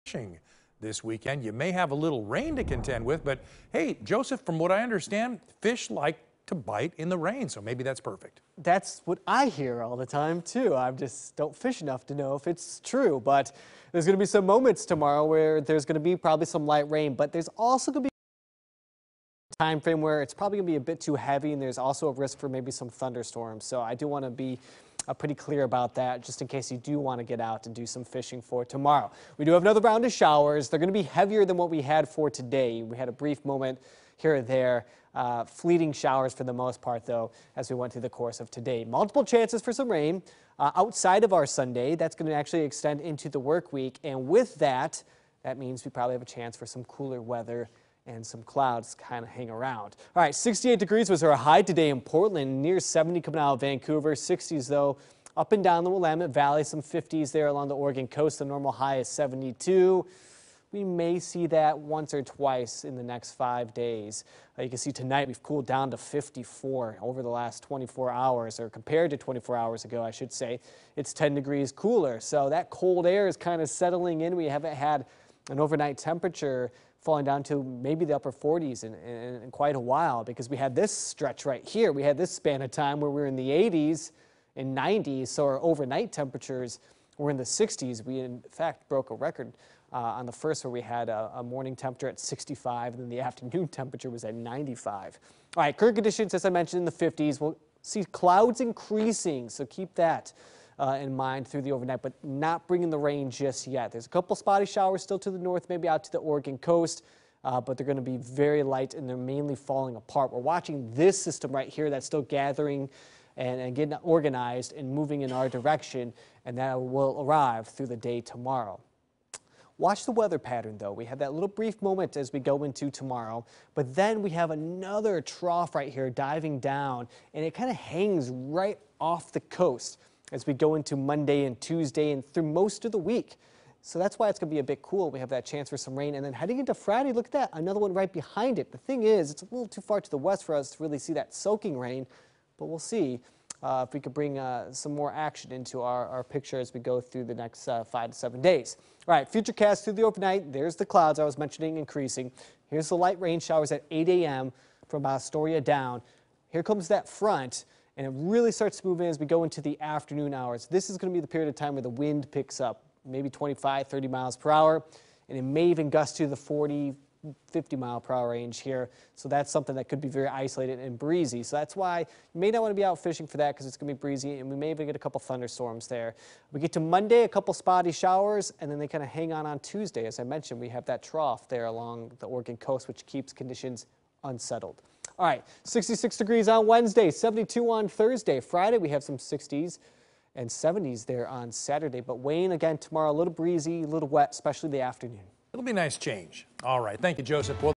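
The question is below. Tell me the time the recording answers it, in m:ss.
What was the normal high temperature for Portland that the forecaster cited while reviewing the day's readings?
0:58.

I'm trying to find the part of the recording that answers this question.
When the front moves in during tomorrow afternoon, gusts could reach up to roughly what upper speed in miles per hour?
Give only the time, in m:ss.
2:46.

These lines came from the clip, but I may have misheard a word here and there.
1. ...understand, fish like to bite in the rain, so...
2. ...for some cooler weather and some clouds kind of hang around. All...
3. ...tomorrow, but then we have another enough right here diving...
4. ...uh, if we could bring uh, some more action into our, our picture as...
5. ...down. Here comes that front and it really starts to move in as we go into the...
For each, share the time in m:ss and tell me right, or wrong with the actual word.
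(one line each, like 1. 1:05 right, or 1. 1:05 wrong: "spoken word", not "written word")
1. 0:04 right
2. 0:46 right
3. 2:02 wrong: "trough", not "enough"
4. 2:23 right
5. 2:35 right.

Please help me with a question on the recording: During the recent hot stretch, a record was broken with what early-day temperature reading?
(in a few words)
65.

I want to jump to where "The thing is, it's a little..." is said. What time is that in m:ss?
2:18.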